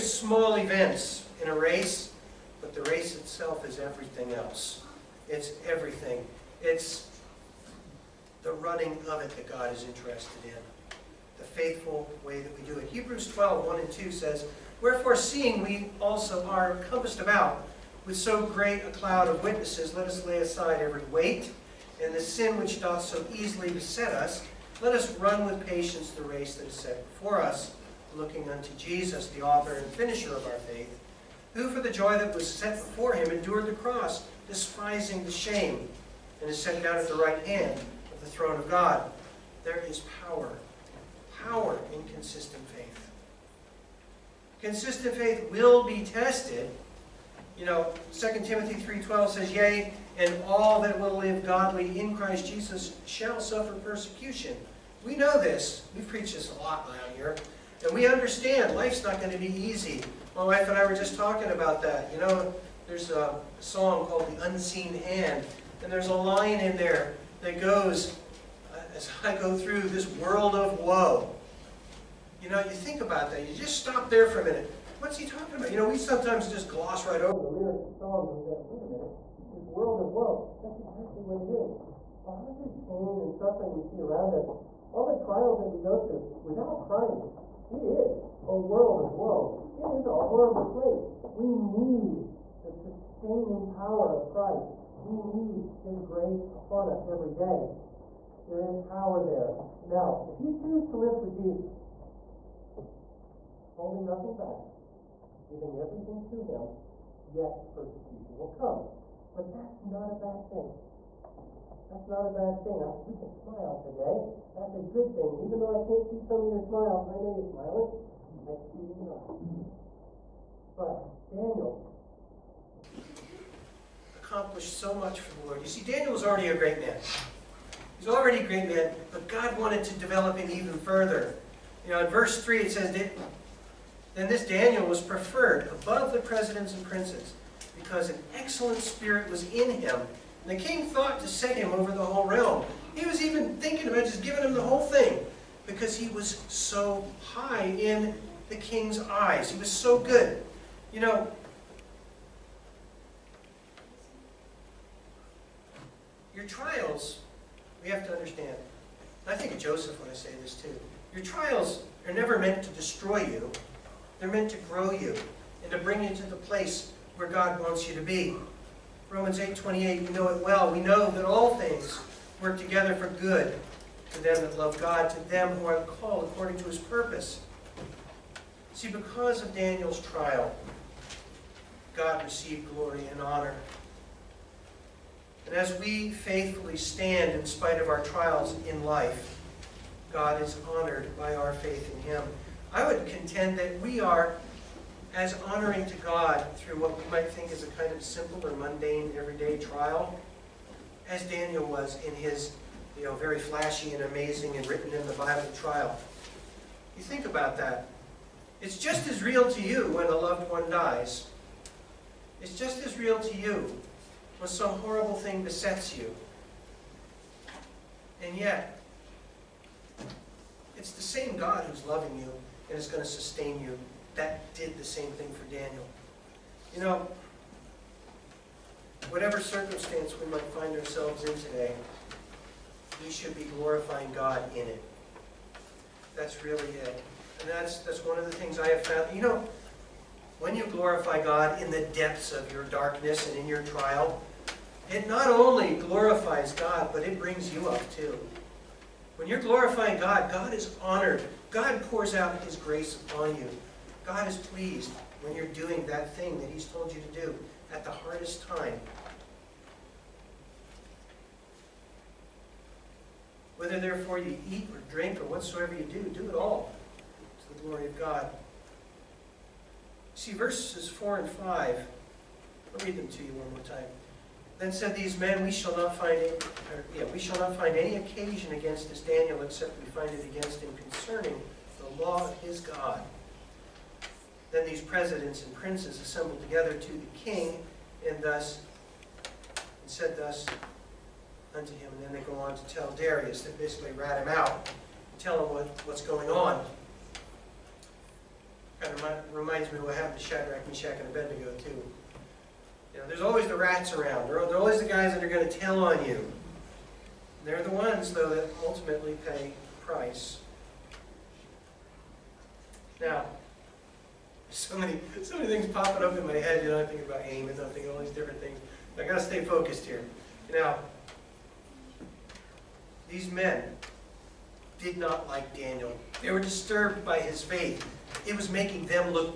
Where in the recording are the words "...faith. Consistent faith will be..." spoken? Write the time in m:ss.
0:42.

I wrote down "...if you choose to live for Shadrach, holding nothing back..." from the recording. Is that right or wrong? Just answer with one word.
wrong.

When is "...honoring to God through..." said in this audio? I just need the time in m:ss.
3:15.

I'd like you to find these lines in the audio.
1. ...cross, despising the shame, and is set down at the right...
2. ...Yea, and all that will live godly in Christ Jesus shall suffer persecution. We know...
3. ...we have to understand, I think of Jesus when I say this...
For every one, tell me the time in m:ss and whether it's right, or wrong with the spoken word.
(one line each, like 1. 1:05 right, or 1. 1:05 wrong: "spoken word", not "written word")
1. 0:33 right
2. 0:49 right
3. 2:37 wrong: "Joseph", not "Jesus".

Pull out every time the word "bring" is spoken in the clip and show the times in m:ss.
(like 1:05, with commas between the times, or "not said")
2:45, 4:07.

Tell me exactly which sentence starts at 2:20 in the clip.
And the king thought to set him over the whole realm.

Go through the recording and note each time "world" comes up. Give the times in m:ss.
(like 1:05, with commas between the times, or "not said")
1:10, 1:19, 1:28.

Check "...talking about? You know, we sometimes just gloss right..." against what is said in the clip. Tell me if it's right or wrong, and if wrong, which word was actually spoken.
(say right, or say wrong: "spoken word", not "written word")
right.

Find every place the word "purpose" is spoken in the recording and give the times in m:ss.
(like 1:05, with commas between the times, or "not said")
2:56.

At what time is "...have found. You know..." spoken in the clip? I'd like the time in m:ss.
3:58.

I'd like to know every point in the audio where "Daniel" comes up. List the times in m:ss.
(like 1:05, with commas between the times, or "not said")
2:01, 2:05, 2:14, 2:59, 3:21, 3:45, 4:38, 5:25.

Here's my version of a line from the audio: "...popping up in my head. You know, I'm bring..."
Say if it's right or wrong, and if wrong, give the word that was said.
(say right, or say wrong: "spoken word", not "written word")
wrong: "thinking", not "bring".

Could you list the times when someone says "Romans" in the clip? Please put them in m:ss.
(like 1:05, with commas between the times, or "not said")
2:49.